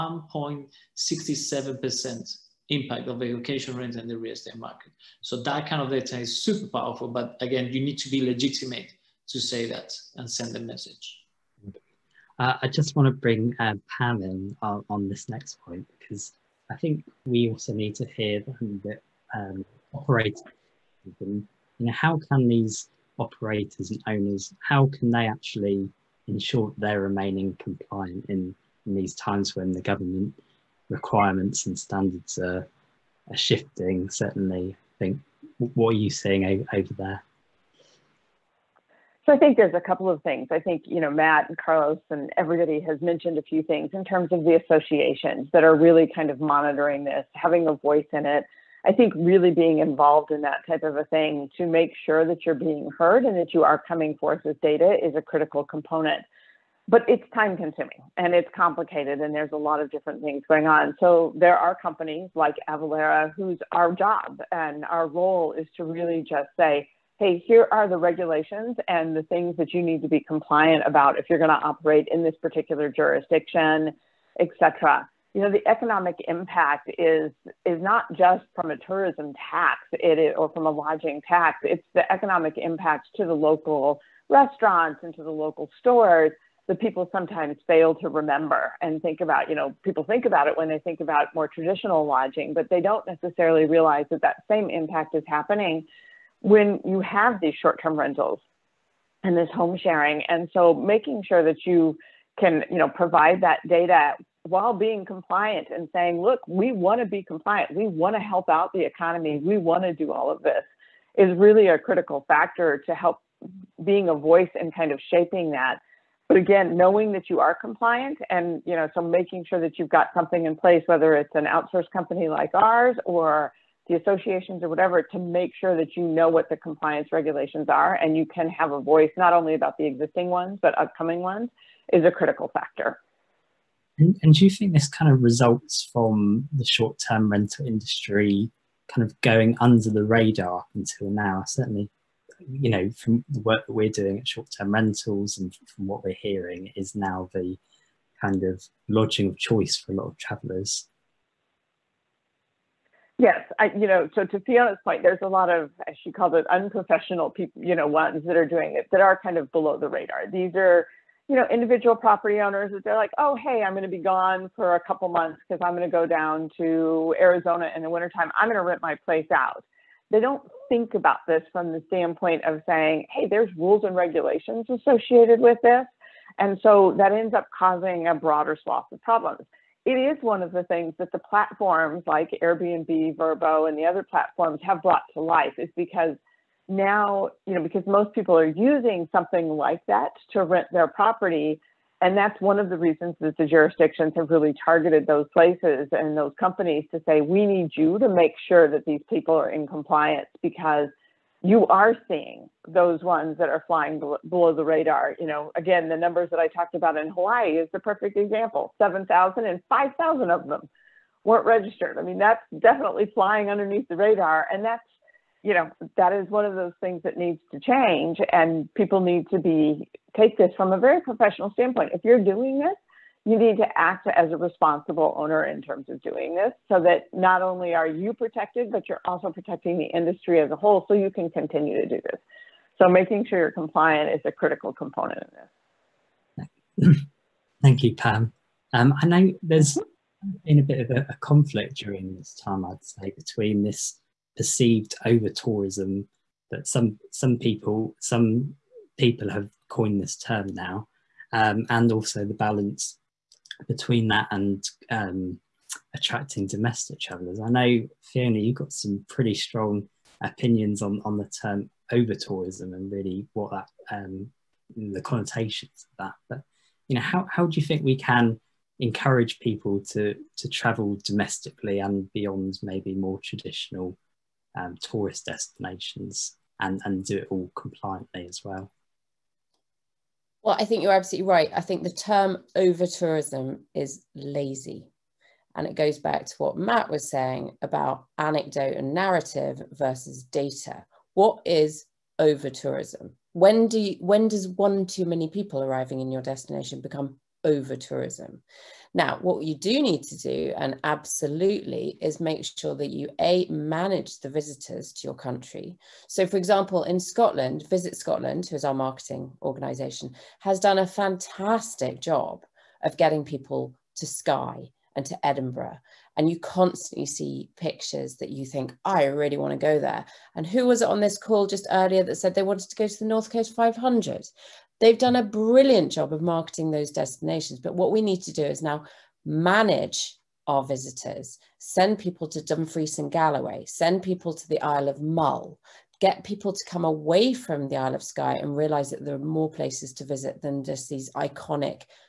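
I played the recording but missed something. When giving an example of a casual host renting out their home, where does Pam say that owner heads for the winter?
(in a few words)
Arizona.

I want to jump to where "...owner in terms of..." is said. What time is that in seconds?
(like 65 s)
225 s.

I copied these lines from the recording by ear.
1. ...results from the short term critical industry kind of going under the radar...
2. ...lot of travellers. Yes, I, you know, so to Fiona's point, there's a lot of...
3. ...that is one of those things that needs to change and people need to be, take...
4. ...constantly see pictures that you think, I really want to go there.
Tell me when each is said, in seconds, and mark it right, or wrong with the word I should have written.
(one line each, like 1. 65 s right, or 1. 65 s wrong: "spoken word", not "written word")
1. 135 s wrong: "rental", not "critical"
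2. 149 s right
3. 215 s right
4. 316 s right.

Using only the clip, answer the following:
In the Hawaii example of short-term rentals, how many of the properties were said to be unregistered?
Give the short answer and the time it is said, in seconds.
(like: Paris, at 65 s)
5,000, at 209 s.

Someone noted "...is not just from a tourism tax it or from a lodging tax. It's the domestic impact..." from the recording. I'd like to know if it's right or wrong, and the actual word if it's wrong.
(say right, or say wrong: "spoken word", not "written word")
wrong: "economic", not "domestic".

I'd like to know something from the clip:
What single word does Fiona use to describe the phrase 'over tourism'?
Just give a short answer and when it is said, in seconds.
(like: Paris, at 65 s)
Lazy, at 284 s.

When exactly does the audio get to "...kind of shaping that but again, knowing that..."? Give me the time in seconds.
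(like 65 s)
114 s.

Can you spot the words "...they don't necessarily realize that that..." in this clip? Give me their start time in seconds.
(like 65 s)
92 s.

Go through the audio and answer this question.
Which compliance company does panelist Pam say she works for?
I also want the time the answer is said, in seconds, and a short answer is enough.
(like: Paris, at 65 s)
Avalara, at 62 s.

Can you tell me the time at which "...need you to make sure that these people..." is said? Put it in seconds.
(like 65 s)
197 s.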